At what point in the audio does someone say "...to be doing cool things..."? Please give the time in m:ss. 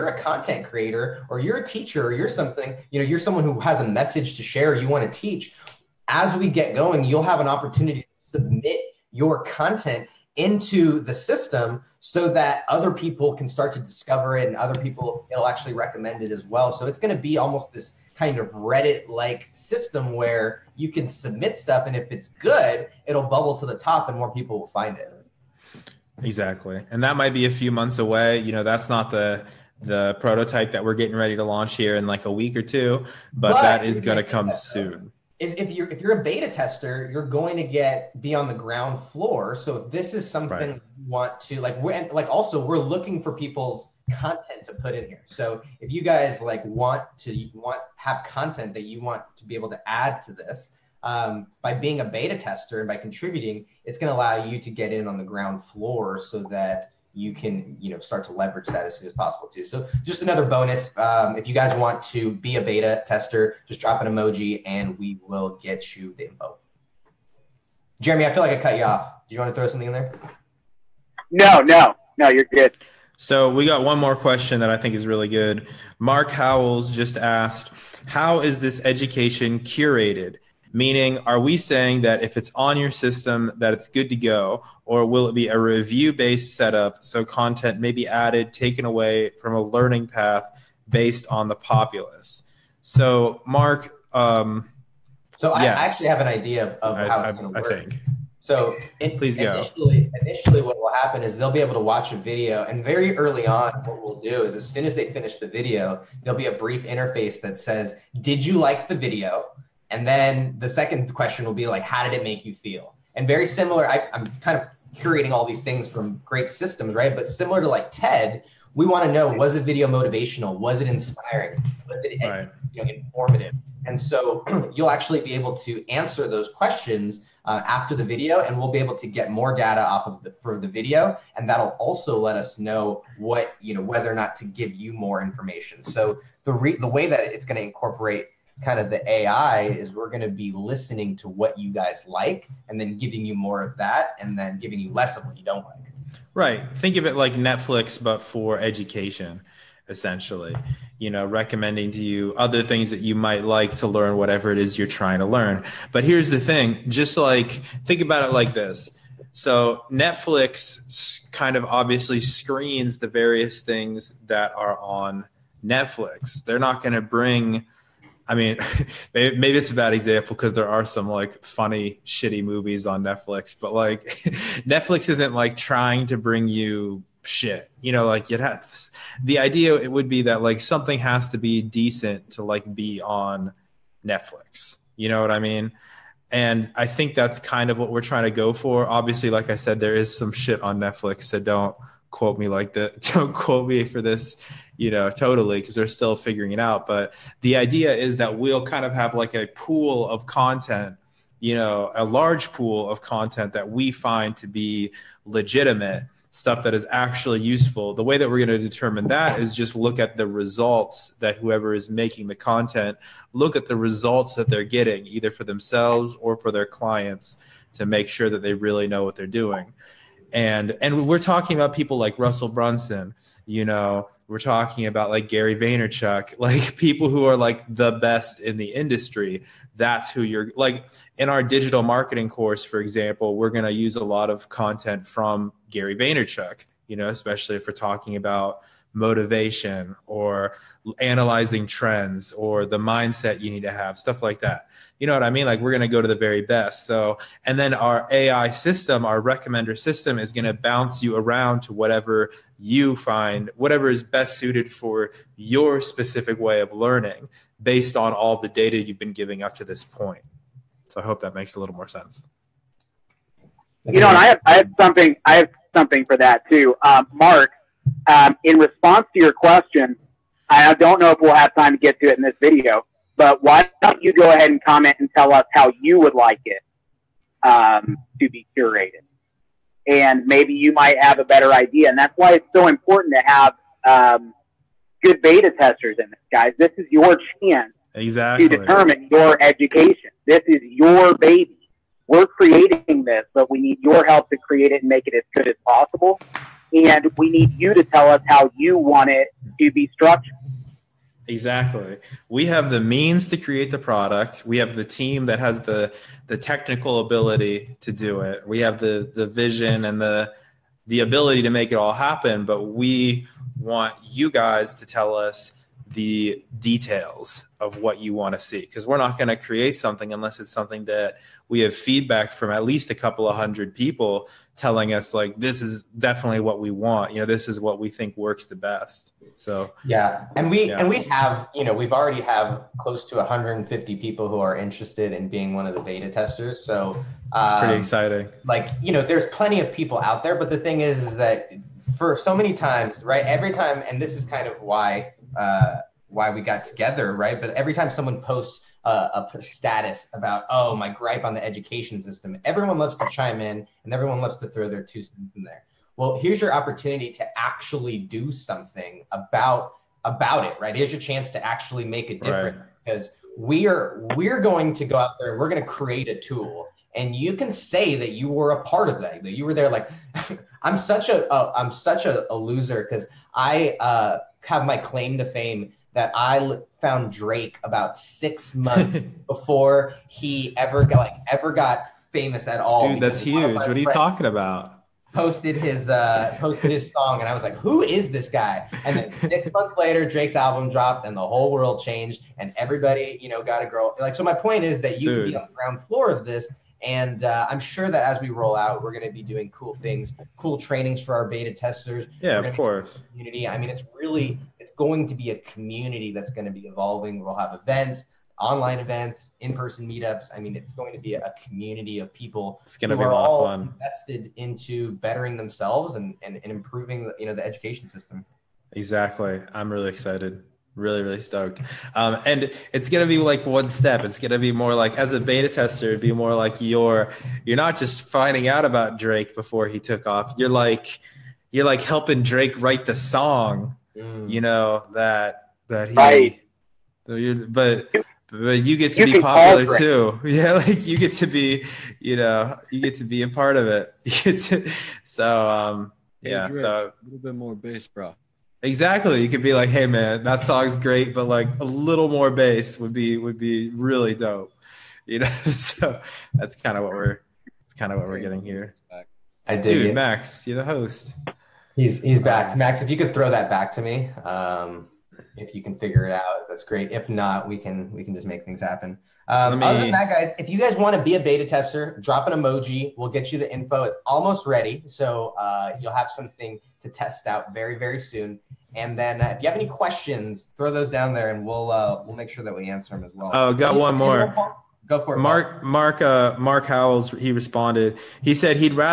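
6:39.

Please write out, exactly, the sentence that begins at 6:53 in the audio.
invested into bettering themselves and, and, and improving, the, you know, the education system.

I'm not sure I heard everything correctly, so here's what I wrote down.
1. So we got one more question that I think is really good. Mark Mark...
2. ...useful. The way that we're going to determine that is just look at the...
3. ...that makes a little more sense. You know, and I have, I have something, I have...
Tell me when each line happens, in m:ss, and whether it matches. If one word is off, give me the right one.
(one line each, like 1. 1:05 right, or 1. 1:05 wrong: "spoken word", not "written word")
1. 1:13 wrong: "Howells", not "Mark"
2. 3:27 right
3. 4:21 right.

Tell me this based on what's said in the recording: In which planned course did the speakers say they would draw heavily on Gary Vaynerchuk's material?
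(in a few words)
Digital marketing.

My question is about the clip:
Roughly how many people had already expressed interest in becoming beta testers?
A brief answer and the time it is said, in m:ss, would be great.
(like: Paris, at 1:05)
150, at 5:33.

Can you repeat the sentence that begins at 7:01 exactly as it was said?
Um, and it's going to be like one step.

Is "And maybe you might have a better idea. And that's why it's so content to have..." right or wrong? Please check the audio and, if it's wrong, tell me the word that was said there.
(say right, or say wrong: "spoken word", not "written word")
wrong: "important", not "content".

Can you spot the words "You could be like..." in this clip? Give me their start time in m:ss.
7:29.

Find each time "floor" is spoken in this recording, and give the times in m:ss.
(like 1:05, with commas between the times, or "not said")
0:39, 0:55, 6:35.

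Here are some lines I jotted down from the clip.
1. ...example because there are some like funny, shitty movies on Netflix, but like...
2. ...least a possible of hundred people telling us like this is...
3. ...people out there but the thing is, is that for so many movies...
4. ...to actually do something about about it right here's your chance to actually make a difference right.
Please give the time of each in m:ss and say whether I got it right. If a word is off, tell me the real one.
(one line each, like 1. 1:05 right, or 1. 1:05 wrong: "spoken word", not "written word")
1. 2:49 right
2. 5:22 wrong: "couple", not "possible"
3. 5:39 wrong: "times", not "movies"
4. 5:57 right.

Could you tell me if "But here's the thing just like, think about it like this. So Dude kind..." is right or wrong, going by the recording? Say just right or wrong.
wrong.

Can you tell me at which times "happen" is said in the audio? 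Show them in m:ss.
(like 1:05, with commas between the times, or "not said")
1:40, 5:11, 7:48.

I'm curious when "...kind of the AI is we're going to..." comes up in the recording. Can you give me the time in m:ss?
2:18.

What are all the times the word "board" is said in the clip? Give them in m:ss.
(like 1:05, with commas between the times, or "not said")
not said.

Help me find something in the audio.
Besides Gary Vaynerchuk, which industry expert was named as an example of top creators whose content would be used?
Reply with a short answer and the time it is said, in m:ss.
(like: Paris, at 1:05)
Russell Brunson, at 3:42.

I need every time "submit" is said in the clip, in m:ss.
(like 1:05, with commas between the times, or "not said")
0:08, 0:21.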